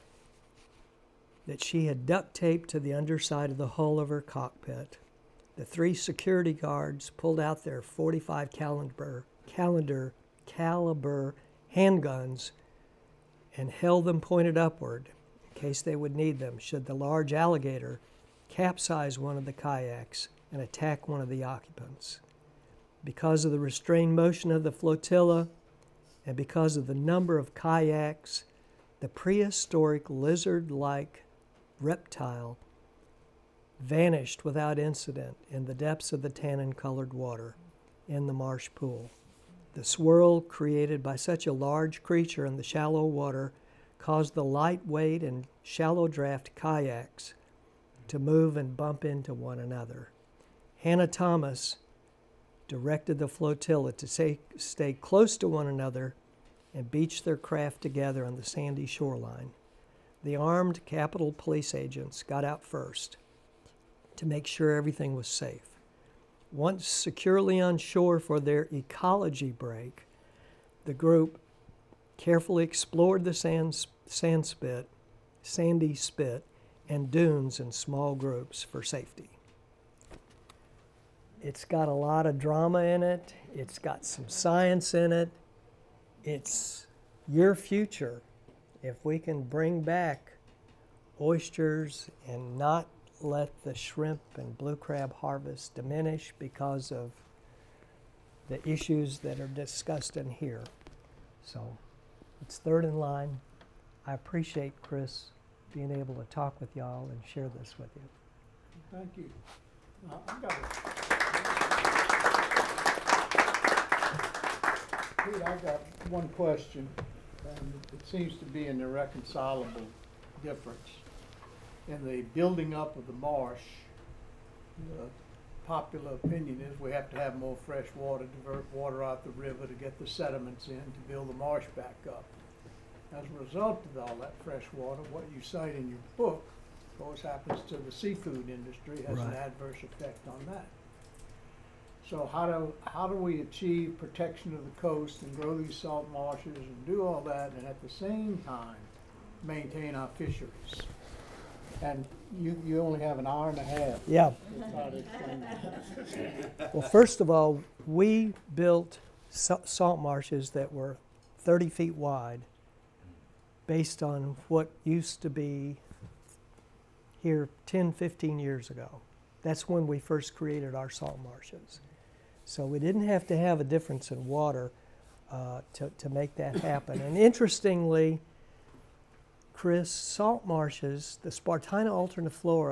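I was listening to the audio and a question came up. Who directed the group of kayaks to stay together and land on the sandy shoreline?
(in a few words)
Hannah Thomas.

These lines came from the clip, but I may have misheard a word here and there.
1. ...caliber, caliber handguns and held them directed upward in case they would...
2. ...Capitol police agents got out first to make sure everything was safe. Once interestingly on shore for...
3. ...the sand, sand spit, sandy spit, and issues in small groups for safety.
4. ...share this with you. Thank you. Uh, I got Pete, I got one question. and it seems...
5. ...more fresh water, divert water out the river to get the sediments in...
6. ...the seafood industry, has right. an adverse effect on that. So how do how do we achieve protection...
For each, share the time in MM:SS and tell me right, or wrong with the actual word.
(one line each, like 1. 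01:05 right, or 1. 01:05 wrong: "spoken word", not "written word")
1. 00:09 wrong: "pointed", not "directed"
2. 01:00 wrong: "securely", not "interestingly"
3. 01:13 wrong: "dunes", not "issues"
4. 01:47 right
5. 02:07 right
6. 02:17 right.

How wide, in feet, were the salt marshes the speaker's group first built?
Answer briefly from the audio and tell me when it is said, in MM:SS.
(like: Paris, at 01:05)
30 feet, at 02:41.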